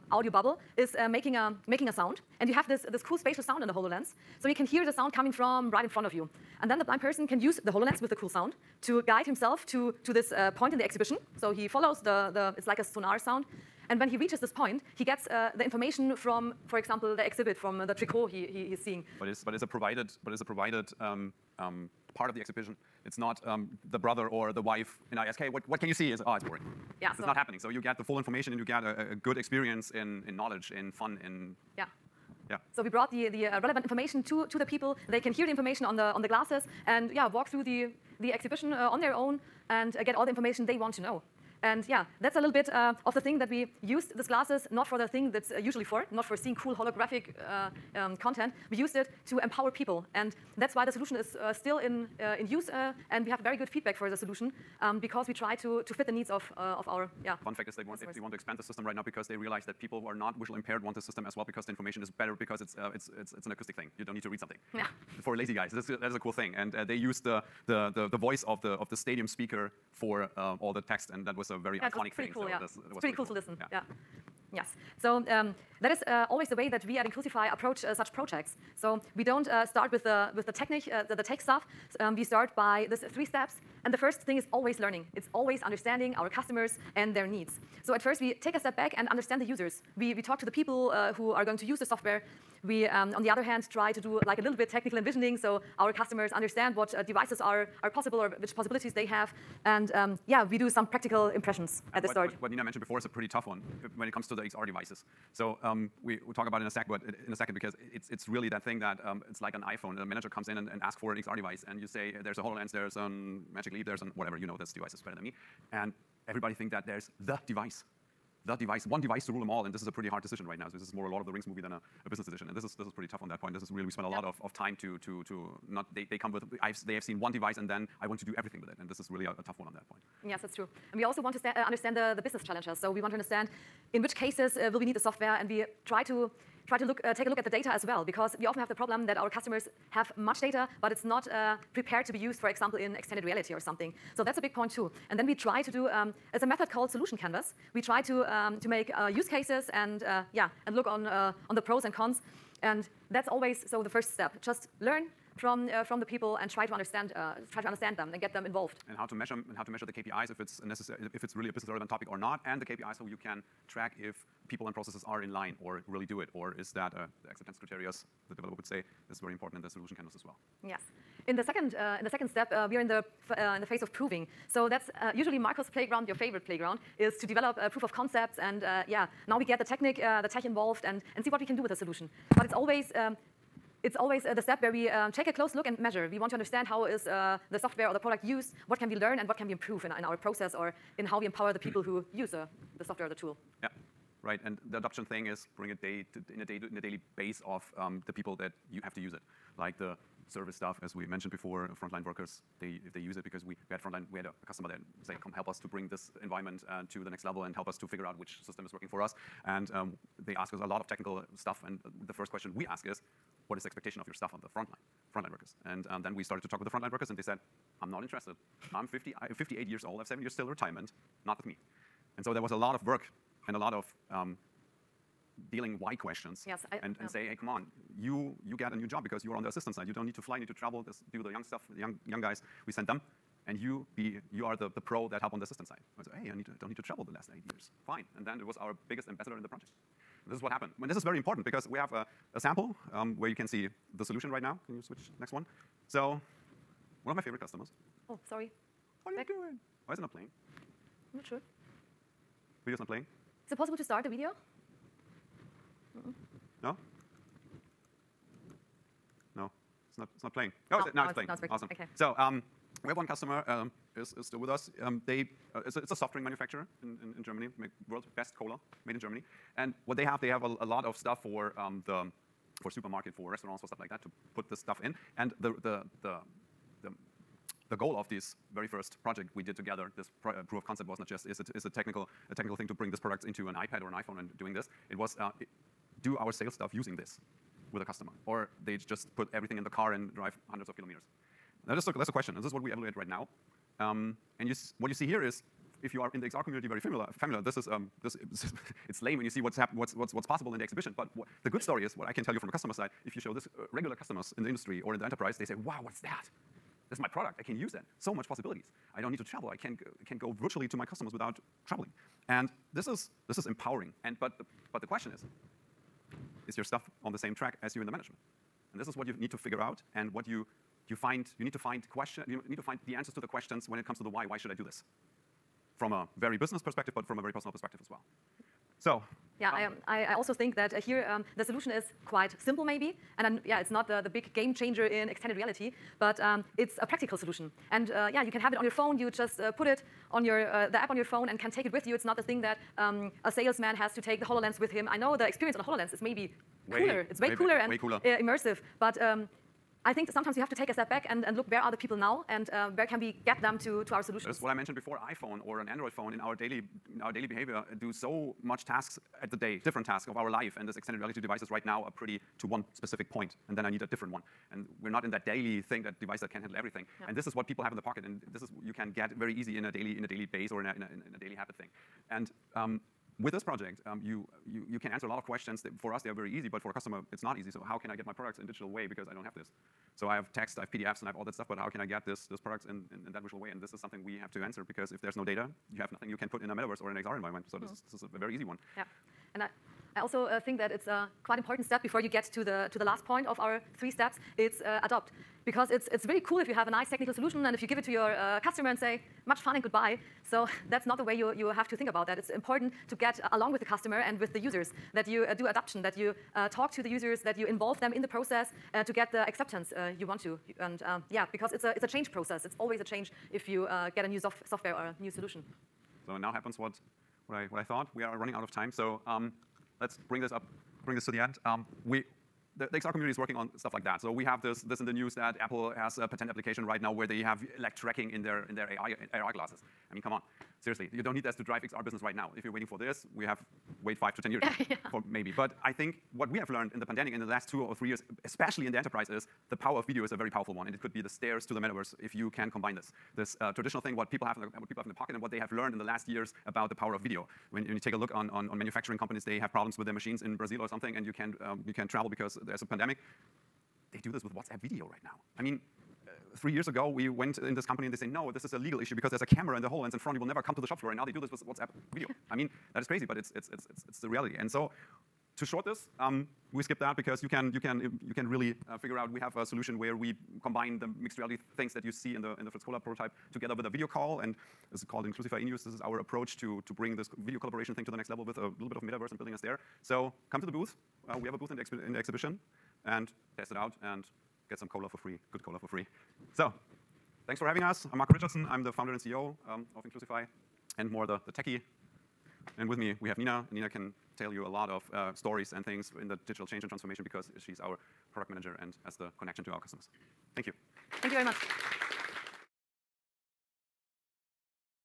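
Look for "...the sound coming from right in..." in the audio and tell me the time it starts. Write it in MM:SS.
00:04.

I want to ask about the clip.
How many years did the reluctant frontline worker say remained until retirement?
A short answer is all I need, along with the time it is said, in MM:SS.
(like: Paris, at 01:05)
7, at 03:40.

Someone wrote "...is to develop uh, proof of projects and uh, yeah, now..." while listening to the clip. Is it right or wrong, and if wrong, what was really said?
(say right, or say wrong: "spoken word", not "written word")
wrong: "concepts", not "projects".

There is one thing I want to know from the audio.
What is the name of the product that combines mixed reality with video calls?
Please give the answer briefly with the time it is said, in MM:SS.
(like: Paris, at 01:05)
Inclusify in use, at 07:55.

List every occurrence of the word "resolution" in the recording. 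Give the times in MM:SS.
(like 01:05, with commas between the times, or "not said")
not said.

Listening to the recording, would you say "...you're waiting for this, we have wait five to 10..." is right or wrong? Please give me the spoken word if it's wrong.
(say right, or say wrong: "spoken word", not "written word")
right.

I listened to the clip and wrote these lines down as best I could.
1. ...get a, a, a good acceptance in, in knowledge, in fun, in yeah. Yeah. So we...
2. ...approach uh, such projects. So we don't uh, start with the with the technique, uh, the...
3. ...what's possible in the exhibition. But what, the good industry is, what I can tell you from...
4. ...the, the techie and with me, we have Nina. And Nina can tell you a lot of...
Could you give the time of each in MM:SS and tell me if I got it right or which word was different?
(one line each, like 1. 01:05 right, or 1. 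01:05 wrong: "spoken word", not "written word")
1. 00:28 wrong: "experience", not "acceptance"
2. 01:17 right
3. 05:00 wrong: "story", not "industry"
4. 08:11 right.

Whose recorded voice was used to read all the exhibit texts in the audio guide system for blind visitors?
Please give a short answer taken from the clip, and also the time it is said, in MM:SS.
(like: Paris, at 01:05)
The stadium speaker, at 01:08.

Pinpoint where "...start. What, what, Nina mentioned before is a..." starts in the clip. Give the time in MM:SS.
01:42.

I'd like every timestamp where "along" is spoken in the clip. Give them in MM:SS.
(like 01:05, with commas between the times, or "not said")
06:43.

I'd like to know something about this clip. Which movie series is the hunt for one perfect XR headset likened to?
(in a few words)
Lord of the Rings.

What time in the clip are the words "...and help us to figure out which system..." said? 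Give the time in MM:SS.
03:27.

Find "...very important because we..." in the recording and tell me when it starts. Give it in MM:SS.
04:01.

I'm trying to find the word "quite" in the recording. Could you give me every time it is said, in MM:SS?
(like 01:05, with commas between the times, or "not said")
05:32, 06:31.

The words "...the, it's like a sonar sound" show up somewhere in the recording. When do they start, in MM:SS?
00:12.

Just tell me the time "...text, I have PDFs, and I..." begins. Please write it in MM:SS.
06:20.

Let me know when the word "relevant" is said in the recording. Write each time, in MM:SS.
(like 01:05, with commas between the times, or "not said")
00:33, 02:41.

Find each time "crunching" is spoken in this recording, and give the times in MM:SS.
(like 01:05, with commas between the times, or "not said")
not said.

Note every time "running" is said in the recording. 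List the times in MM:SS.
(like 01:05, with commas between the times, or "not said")
06:58.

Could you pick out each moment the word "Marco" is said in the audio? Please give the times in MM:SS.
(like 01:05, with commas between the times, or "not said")
02:55, 08:07.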